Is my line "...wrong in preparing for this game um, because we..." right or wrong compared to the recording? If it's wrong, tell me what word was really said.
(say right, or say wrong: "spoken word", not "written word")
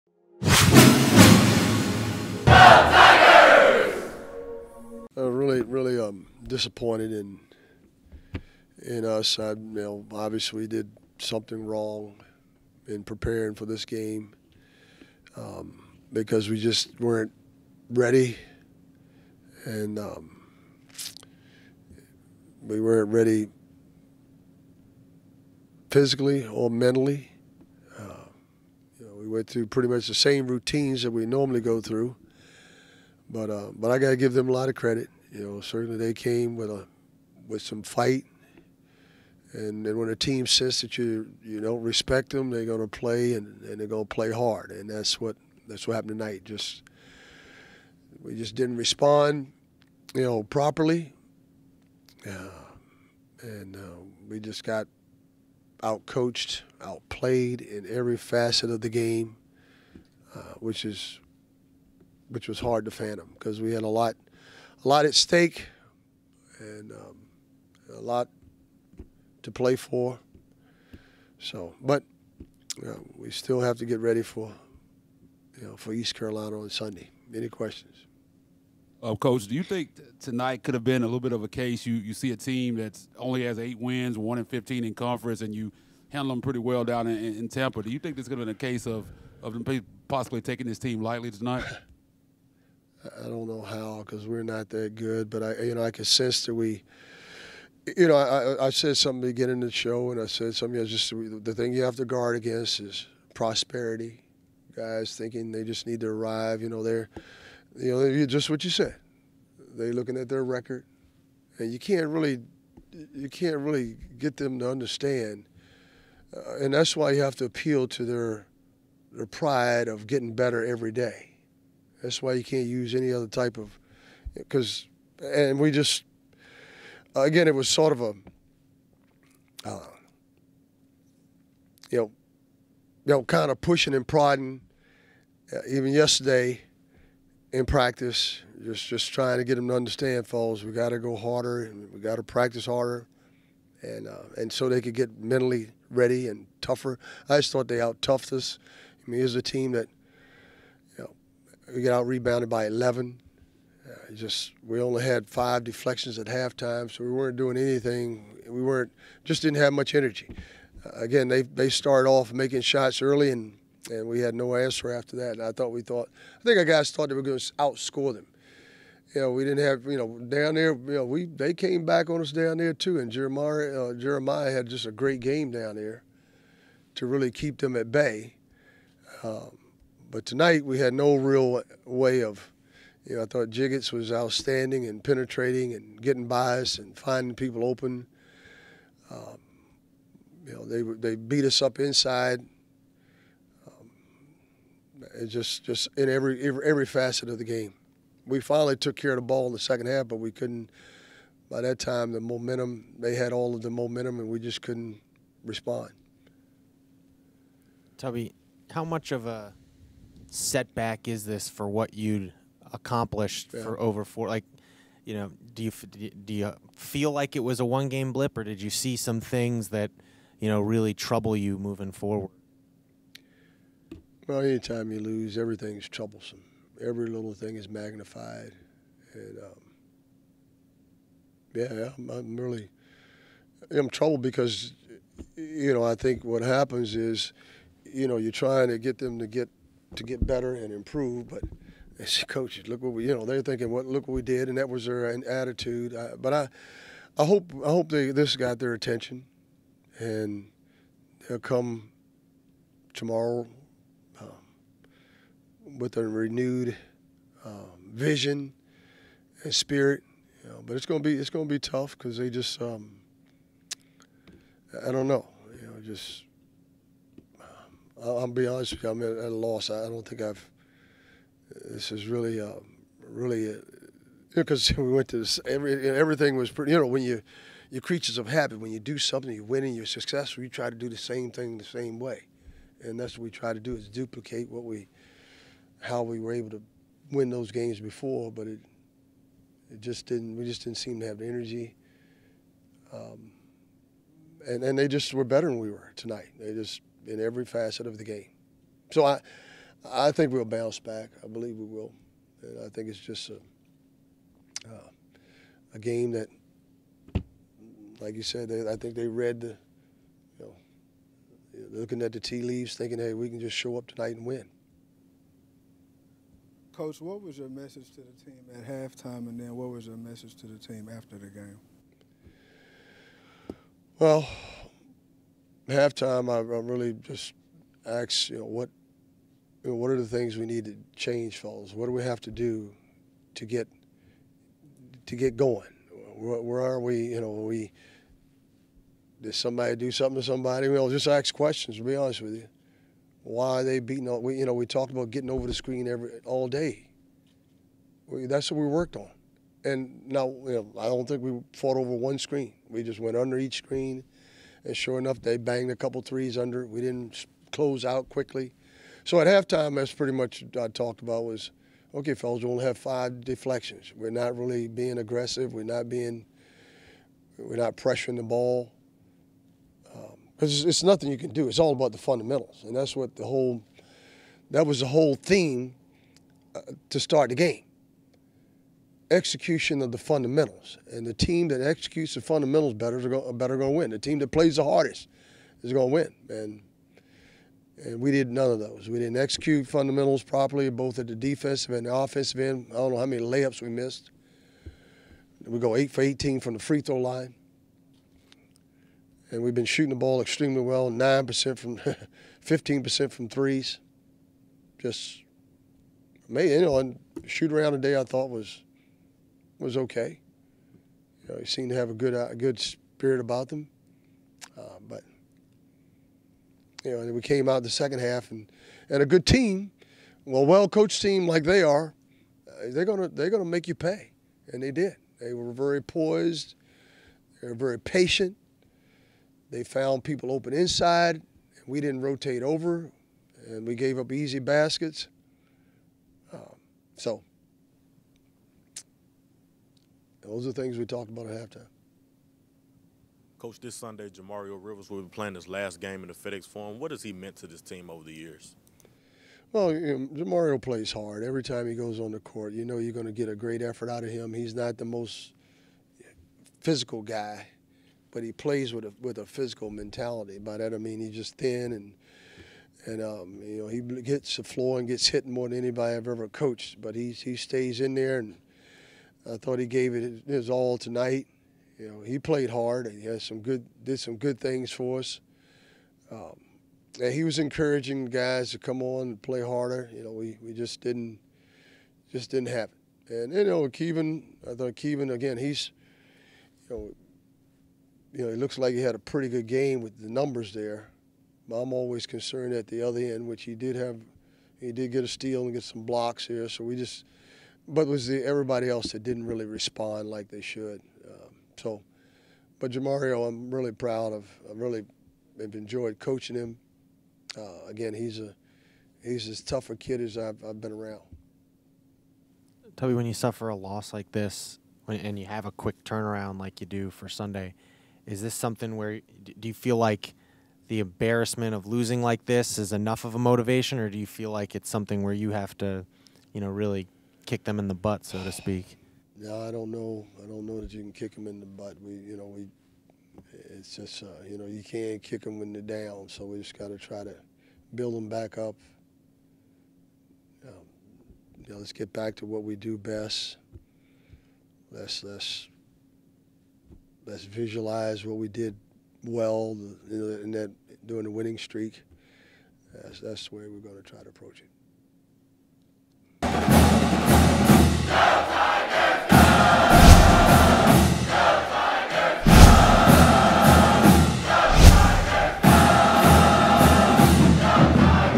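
right.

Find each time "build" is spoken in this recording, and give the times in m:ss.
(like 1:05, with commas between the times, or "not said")
8:57.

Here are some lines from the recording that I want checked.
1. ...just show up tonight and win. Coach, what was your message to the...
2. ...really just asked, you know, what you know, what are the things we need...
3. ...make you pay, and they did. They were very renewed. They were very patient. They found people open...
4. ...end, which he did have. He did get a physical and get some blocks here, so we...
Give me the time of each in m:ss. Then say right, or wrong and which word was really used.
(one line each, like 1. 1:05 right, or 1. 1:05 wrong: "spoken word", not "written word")
1. 5:13 right
2. 5:26 right
3. 7:03 wrong: "poised", not "renewed"
4. 8:12 wrong: "steal", not "physical".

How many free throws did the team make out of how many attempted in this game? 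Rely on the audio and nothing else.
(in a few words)
8 for 18.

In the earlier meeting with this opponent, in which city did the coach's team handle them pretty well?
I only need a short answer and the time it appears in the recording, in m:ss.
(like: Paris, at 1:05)
Tampa, at 1:27.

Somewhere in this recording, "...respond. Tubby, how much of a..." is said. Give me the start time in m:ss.
3:25.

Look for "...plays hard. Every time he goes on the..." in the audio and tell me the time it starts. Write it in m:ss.
7:30.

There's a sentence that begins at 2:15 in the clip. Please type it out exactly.
Uh, even yesterday, in practice, just just trying to get them to understand, falls.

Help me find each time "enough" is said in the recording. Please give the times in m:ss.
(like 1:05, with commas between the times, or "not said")
5:54, 8:42.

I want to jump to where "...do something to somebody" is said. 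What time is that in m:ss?
5:39.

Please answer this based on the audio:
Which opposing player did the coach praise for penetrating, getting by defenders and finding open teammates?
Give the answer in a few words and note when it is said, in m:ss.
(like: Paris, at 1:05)
Jiggetts, at 3:03.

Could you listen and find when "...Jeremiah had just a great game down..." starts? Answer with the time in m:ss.
2:53.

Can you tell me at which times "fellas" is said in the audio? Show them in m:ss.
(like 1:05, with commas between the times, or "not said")
5:31, 6:02.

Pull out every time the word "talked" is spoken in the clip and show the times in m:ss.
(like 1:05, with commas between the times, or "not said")
5:44, 6:00, 7:20.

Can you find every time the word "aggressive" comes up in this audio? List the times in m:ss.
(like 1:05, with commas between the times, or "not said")
6:04.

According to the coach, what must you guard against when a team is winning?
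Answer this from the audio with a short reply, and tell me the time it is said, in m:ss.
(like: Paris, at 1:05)
Prosperity, at 1:43.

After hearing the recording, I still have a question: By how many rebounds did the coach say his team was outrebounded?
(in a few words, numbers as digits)
11.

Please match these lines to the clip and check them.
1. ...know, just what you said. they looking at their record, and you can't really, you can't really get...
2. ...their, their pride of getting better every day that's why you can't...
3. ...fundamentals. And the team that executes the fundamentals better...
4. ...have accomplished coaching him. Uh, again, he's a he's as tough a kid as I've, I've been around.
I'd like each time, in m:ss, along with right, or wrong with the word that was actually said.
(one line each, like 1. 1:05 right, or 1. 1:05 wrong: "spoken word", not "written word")
1. 1:47 right
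2. 1:58 right
3. 6:19 right
4. 8:25 wrong: "enjoyed", not "accomplished".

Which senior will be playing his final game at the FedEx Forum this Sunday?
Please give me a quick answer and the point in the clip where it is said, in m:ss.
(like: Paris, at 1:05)
Jimario Rivers, at 7:24.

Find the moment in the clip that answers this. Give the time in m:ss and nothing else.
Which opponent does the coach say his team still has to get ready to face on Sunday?
1:15.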